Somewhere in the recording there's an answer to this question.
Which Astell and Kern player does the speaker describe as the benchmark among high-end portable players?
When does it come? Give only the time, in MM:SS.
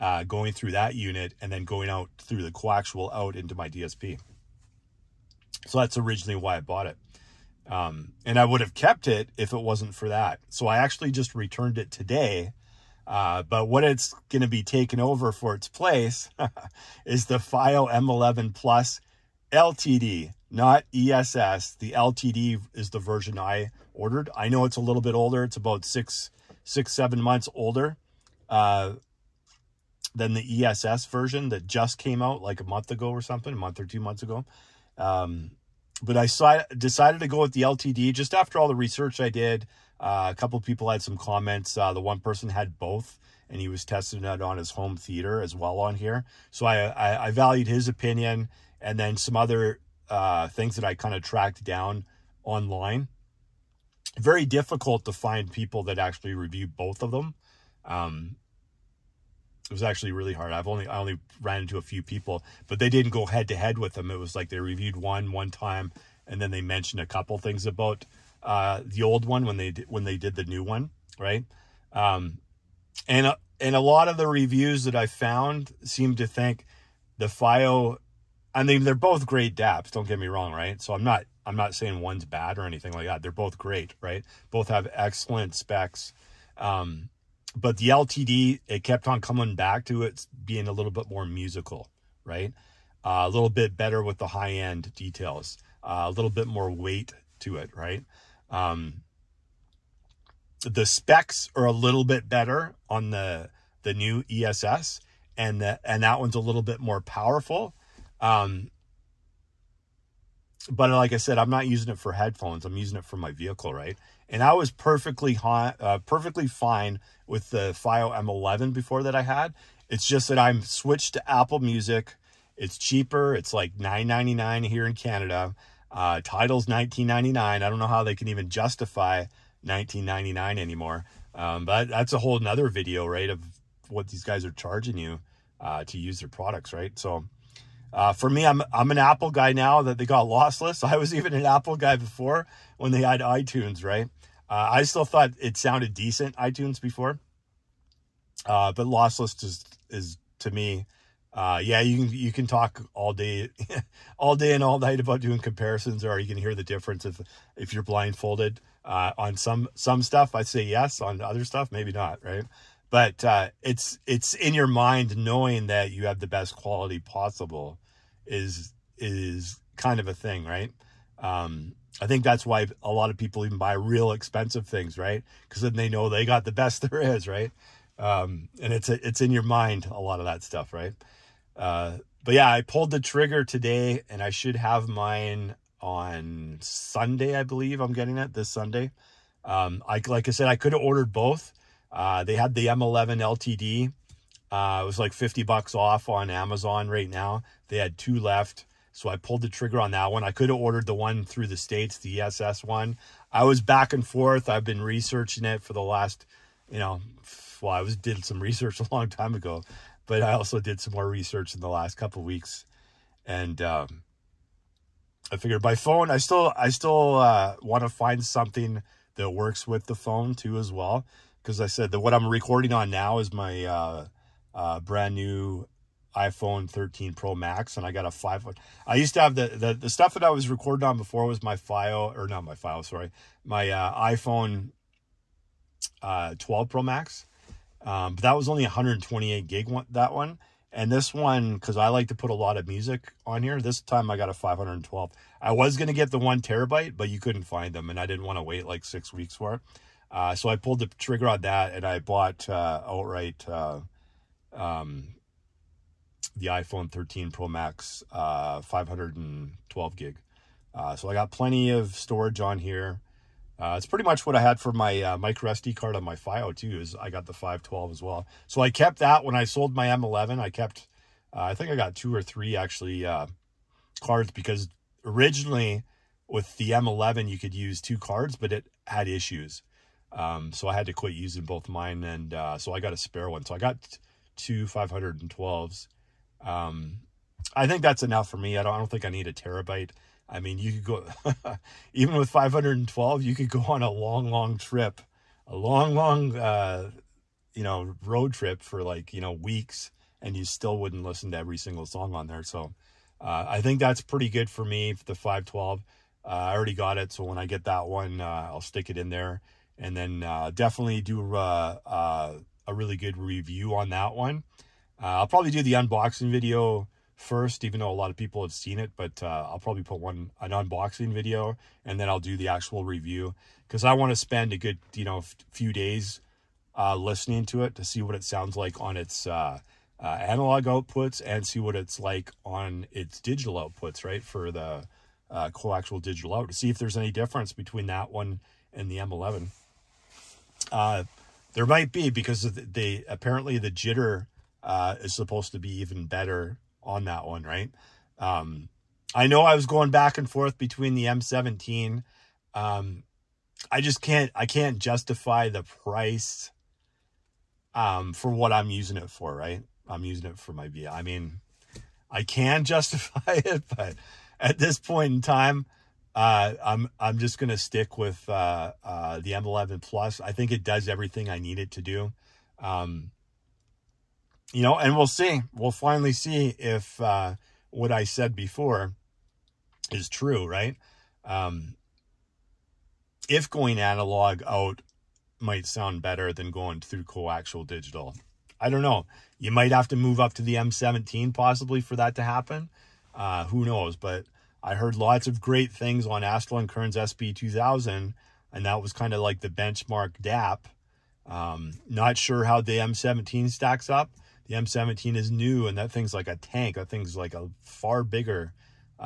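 06:36.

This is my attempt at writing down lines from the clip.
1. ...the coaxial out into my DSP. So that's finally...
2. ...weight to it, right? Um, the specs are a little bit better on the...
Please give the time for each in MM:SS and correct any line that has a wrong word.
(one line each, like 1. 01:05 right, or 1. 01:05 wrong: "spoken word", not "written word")
1. 00:02 wrong: "originally", not "finally"
2. 01:36 right.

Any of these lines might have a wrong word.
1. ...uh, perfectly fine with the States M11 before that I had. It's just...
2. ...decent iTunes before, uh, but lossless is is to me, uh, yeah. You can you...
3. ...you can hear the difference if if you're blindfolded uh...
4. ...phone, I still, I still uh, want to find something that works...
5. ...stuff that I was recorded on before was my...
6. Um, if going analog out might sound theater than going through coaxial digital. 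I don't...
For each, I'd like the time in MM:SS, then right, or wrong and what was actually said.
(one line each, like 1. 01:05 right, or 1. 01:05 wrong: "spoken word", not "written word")
1. 01:55 wrong: "FiiO", not "States"
2. 02:25 right
3. 02:36 right
4. 03:35 right
5. 03:49 right
6. 06:21 wrong: "better", not "theater".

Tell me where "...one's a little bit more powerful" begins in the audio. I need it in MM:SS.
01:46.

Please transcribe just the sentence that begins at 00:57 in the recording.
Um, it was actually really hard.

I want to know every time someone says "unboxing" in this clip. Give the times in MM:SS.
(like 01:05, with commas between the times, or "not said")
05:15, 05:20.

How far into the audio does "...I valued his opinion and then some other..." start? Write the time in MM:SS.
00:47.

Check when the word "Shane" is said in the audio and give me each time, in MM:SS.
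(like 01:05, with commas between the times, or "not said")
not said.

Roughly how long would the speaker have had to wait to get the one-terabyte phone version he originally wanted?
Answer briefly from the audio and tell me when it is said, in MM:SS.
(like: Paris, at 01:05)
6 weeks, at 04:08.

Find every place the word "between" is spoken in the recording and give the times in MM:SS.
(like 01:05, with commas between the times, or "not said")
05:37, 05:50.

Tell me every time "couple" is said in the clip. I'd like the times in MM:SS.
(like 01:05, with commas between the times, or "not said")
00:40, 01:07, 03:31.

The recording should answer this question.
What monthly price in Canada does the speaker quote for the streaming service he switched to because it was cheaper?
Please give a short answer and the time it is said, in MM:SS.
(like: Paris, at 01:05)
$9.99, at 02:03.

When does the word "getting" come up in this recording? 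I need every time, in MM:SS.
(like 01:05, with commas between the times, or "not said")
03:07.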